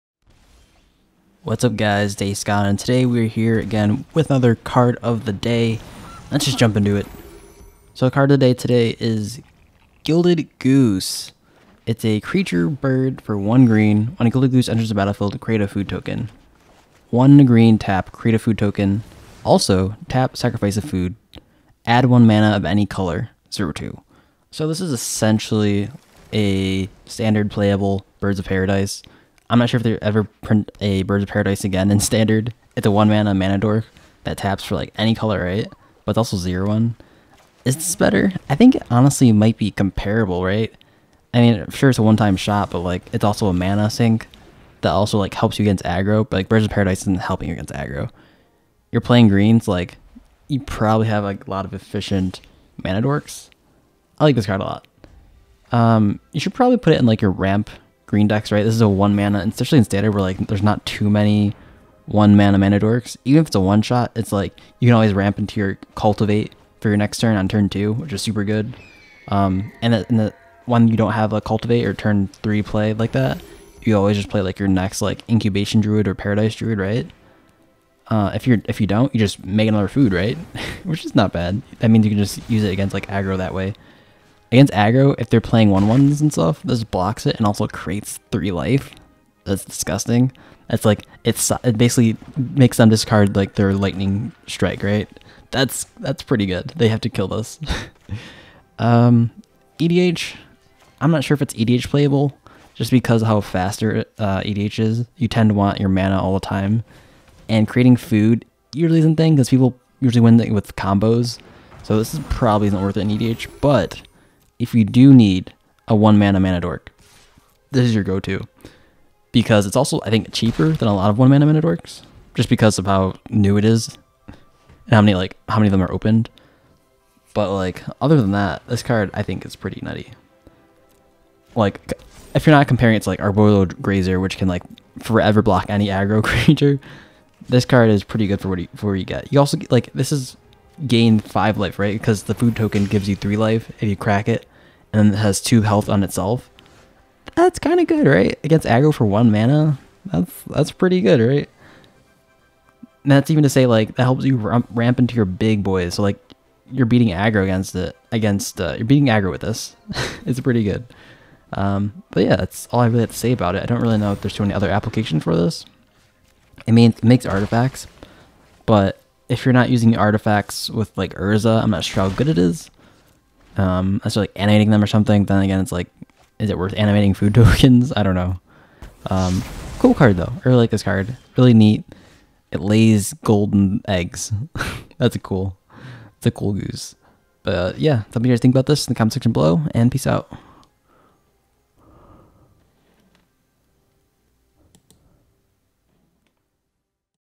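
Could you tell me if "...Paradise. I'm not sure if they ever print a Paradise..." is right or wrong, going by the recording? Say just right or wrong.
wrong.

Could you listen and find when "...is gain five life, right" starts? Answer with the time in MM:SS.
02:20.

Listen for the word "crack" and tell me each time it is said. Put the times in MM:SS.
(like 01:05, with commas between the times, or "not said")
02:23.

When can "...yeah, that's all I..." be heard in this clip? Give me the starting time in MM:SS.
02:42.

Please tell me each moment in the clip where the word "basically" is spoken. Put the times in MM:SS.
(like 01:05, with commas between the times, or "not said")
01:31.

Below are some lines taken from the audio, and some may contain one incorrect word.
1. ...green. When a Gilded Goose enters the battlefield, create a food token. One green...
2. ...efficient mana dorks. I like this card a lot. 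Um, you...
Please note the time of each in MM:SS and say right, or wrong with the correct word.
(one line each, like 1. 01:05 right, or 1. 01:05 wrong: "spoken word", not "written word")
1. 00:13 right
2. 00:51 right.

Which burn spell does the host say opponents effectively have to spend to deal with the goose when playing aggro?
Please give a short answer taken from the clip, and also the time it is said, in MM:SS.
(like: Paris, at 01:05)
Lightning Strike, at 01:33.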